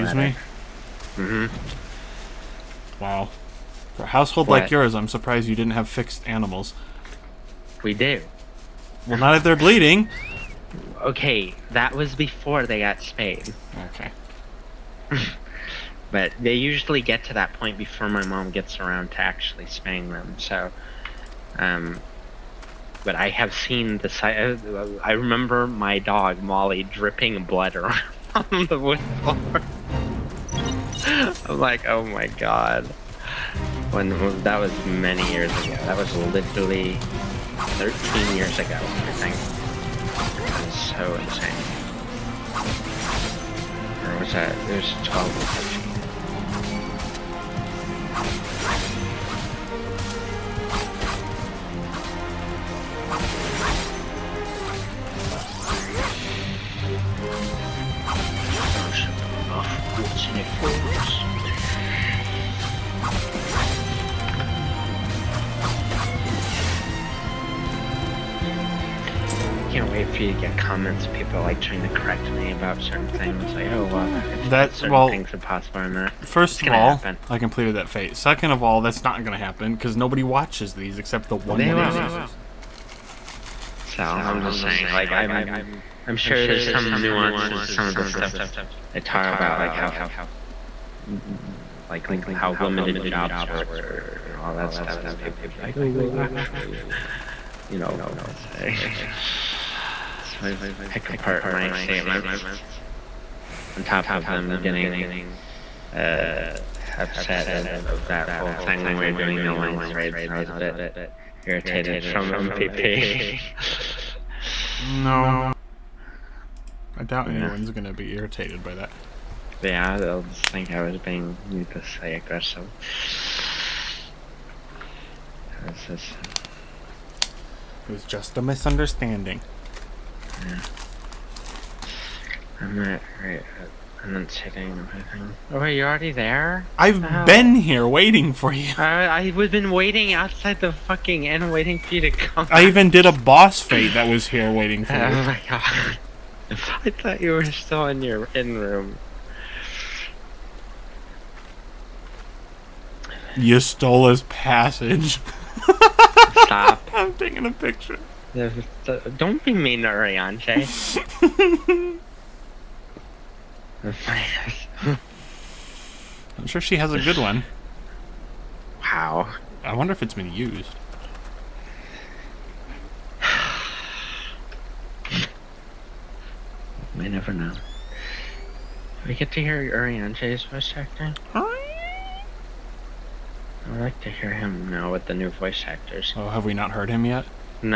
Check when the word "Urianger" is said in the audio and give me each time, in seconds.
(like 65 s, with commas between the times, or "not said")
159 s, 179 s.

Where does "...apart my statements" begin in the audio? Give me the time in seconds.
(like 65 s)
101 s.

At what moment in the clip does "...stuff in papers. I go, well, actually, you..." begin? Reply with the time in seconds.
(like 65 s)
94 s.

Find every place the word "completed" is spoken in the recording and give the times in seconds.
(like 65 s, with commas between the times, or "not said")
77 s.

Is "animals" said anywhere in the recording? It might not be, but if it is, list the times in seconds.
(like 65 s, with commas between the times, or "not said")
6 s.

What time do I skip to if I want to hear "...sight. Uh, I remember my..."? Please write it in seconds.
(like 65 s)
24 s.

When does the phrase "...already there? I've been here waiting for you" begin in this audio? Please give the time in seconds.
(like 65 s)
135 s.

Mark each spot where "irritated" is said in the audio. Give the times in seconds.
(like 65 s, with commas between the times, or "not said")
111 s, 118 s.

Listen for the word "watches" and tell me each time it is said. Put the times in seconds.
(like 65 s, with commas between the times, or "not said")
80 s.